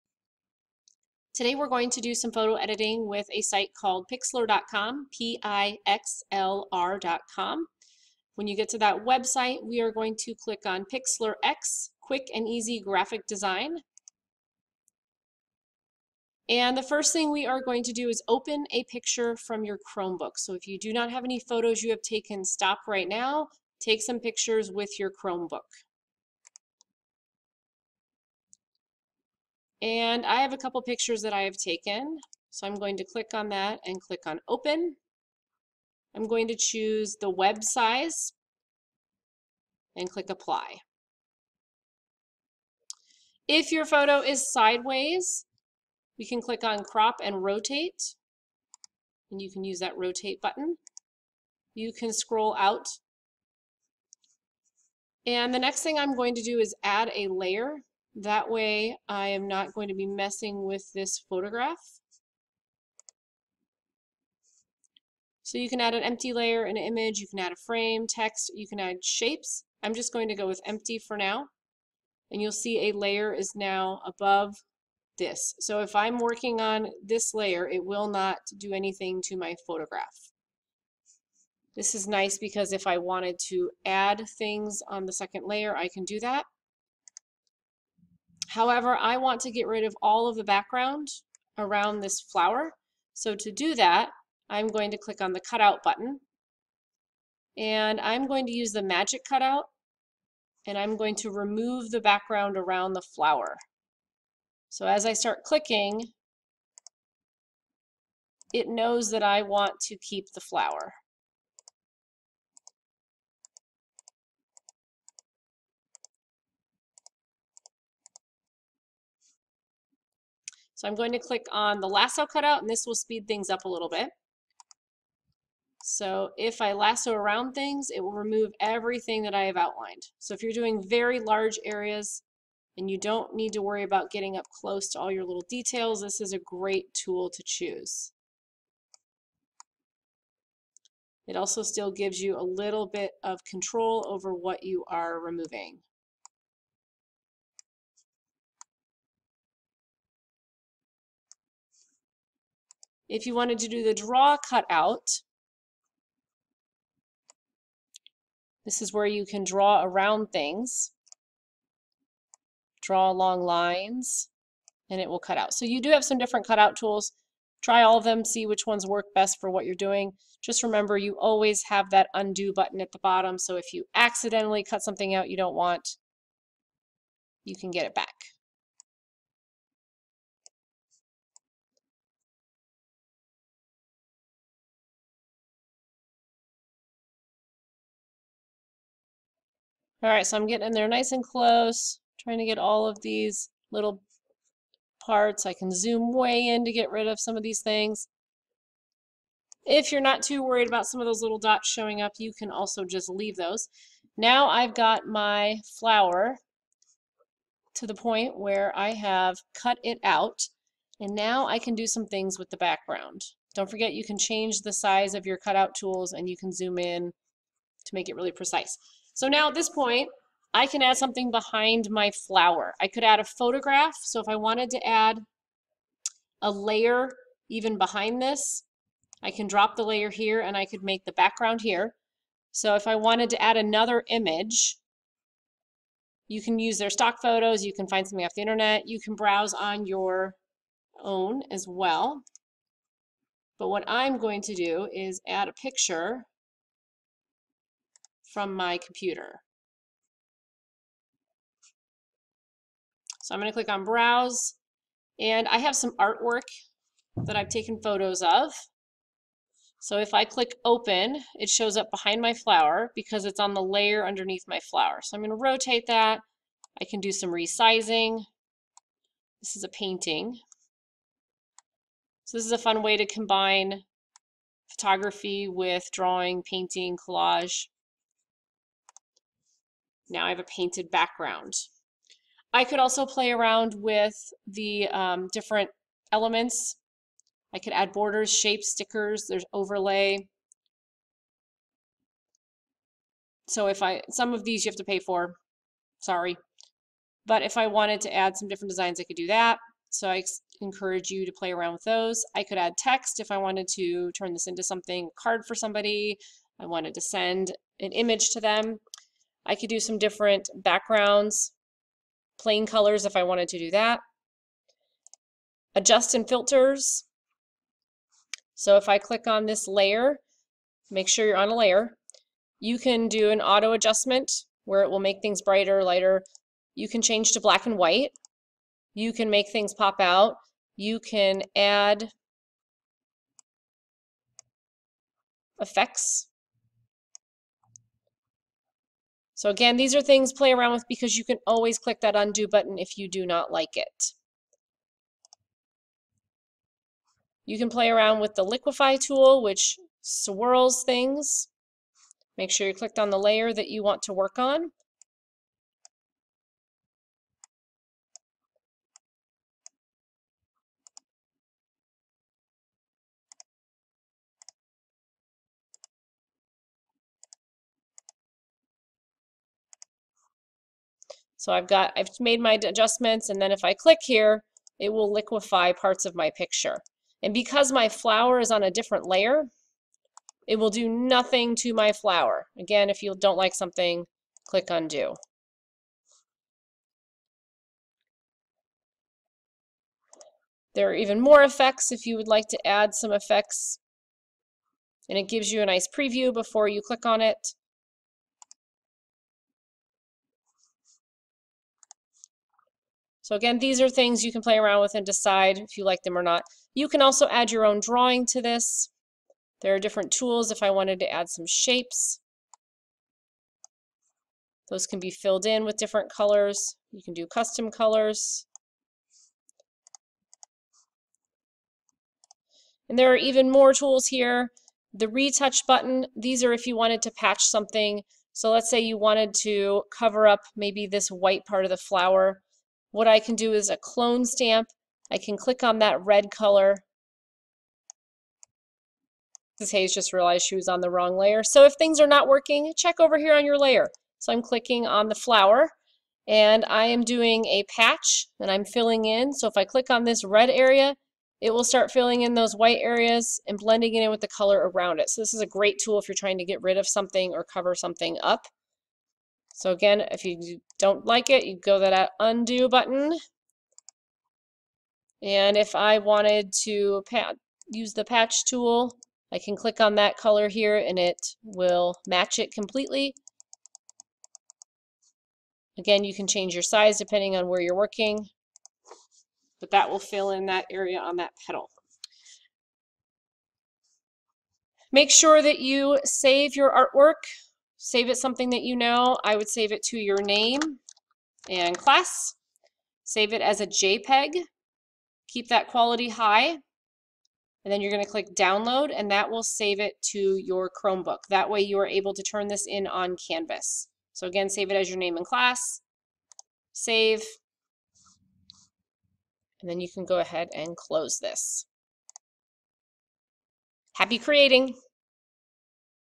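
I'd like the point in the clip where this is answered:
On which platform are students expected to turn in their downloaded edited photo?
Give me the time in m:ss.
8:23.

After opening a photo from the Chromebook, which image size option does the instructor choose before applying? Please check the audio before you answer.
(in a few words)
web size.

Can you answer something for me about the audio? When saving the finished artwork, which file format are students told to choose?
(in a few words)
JPEG.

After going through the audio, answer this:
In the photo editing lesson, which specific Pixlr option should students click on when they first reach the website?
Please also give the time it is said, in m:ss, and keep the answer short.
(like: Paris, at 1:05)
Pixlr X, at 0:10.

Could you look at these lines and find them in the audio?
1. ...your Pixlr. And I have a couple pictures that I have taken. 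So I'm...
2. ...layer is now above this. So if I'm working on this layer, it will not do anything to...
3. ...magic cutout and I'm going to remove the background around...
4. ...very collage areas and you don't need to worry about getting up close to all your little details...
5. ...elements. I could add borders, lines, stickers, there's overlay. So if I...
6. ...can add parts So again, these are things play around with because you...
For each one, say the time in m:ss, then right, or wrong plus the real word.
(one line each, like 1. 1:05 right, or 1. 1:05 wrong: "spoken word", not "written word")
1. 0:24 wrong: "Chromebook", not "Pixlr"
2. 1:12 right
3. 1:38 right
4. 2:10 wrong: "large", not "collage"
5. 4:46 wrong: "shapes", not "lines"
6. 5:30 wrong: "effects", not "parts".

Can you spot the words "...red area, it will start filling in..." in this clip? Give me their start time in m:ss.
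7:30.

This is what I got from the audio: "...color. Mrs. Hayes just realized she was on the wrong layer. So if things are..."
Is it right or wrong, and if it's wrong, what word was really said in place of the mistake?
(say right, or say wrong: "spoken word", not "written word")
right.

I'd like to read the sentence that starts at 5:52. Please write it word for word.
Make sure you clicked on the layer that you want to work on.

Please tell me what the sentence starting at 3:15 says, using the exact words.
I can zoom way in to get rid of some of these things.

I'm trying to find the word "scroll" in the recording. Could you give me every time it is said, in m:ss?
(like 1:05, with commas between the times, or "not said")
0:52.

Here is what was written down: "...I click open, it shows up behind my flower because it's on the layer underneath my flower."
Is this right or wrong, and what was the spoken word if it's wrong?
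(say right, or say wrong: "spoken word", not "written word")
right.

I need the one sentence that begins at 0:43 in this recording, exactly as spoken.
If your photo is sideways, we can click on crop and rotate.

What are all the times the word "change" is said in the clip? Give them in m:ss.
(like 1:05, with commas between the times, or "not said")
3:34, 5:27, 7:56.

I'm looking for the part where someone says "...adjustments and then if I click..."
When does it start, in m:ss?
6:12.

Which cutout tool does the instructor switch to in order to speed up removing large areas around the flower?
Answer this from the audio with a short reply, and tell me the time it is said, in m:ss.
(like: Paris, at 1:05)
lasso cutout, at 2:01.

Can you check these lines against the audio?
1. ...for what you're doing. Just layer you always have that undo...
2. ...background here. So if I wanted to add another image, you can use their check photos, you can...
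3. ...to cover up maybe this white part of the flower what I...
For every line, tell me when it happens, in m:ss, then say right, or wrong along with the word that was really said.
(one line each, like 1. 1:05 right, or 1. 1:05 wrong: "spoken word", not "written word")
1. 2:49 wrong: "remember", not "layer"
2. 3:51 wrong: "stock", not "check"
3. 7:09 right.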